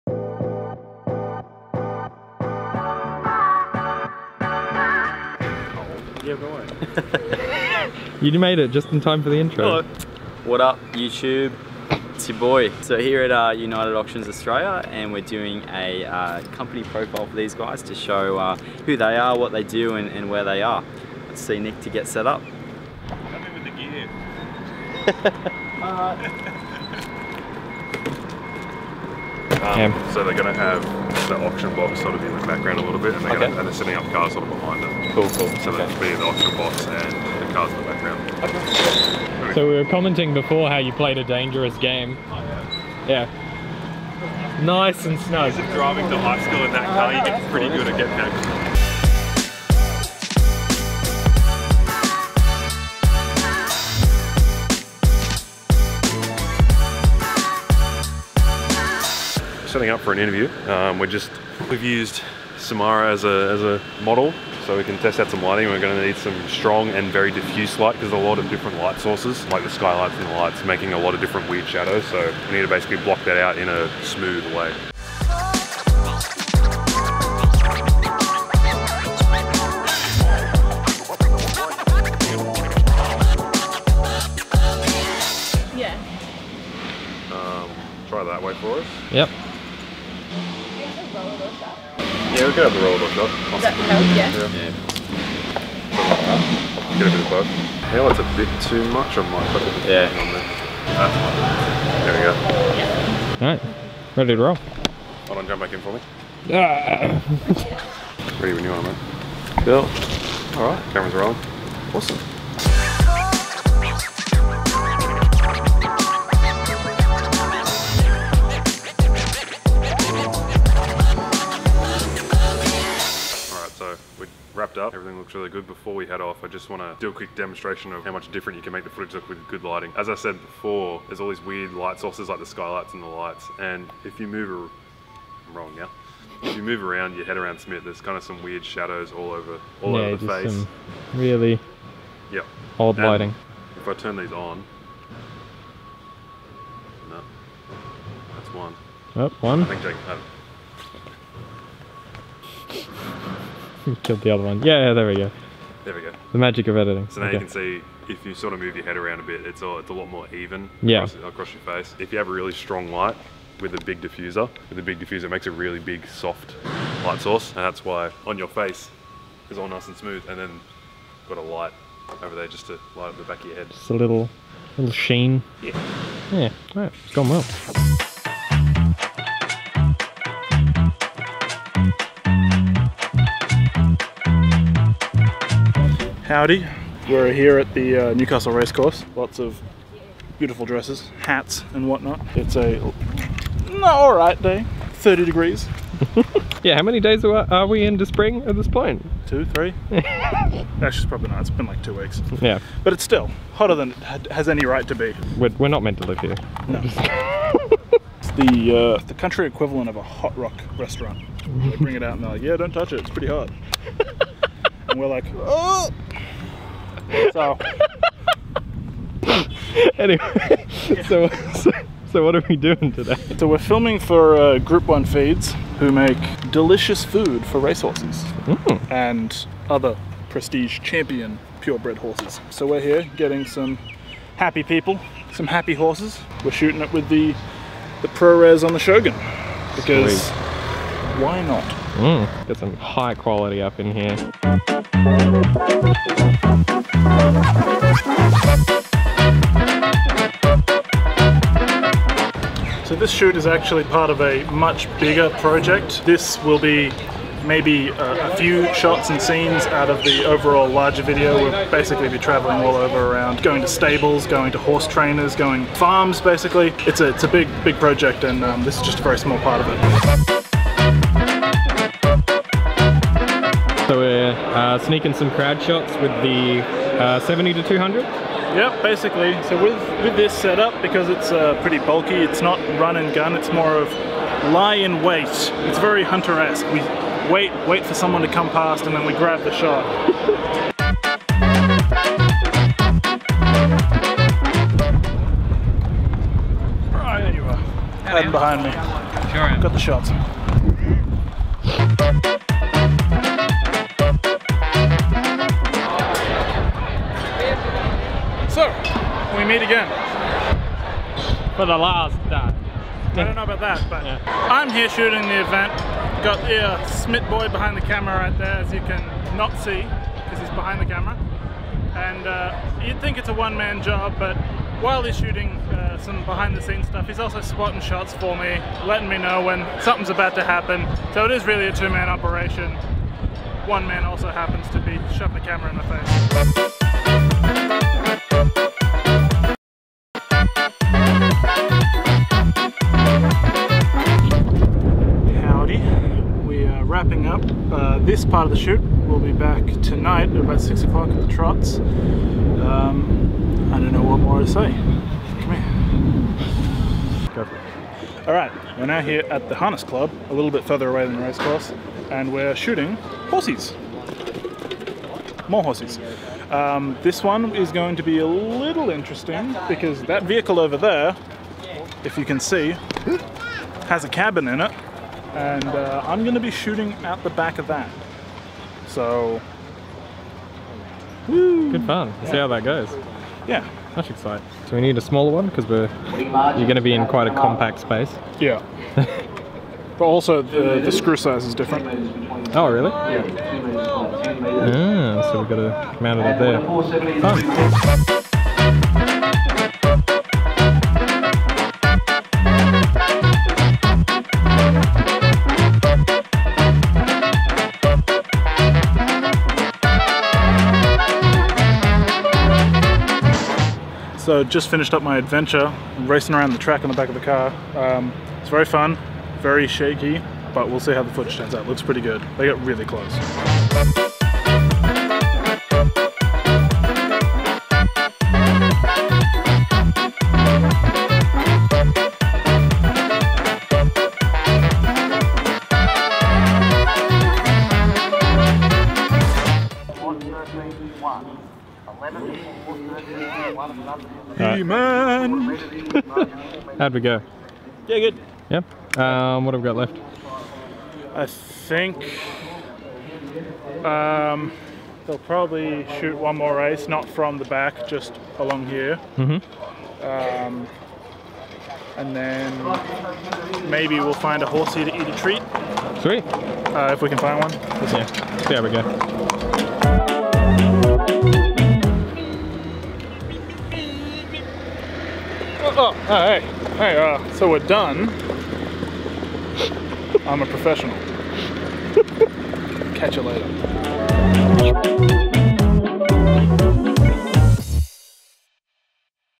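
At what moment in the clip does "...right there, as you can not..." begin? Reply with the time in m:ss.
5:18.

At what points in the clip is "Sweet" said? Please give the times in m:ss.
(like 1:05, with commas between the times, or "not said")
4:00, 7:46.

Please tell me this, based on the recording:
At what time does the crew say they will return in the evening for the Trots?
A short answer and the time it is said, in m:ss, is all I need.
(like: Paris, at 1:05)
6 o'clock, at 5:50.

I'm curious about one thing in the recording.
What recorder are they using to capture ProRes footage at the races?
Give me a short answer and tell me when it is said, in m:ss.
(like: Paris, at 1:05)
Shogun, at 3:58.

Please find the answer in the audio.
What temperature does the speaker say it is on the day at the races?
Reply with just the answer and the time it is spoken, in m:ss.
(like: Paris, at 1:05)
30 degrees, at 3:14.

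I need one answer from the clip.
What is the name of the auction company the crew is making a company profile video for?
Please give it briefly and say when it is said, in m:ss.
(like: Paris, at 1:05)
United Auctions Australia, at 0:13.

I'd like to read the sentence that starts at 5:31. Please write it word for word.
So it is really a two-man operation.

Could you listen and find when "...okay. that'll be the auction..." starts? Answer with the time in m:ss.
0:35.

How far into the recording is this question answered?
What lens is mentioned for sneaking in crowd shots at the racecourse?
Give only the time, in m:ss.
4:37.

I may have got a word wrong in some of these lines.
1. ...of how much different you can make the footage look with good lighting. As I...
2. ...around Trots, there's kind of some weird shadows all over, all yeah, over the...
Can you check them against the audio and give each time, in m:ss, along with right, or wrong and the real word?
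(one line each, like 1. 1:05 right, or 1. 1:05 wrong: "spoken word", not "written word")
1. 2:07 right
2. 2:17 wrong: "Smith", not "Trots".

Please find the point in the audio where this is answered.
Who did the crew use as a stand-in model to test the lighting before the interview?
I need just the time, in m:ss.
1:02.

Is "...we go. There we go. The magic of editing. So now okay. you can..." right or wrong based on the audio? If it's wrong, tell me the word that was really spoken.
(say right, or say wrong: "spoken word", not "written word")
right.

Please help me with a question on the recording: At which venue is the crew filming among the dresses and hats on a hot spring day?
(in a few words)
Newcastle Racecourse.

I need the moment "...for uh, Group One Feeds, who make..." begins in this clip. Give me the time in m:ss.
3:43.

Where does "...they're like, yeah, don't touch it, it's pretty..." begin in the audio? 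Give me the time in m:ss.
3:32.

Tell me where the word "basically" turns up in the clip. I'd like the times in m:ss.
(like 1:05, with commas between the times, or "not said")
1:12, 4:21, 4:26, 4:38.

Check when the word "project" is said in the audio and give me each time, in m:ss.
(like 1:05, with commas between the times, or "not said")
4:15, 4:27.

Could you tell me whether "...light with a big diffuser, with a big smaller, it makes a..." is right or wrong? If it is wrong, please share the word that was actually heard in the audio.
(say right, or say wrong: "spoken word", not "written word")
wrong: "diffuser", not "smaller".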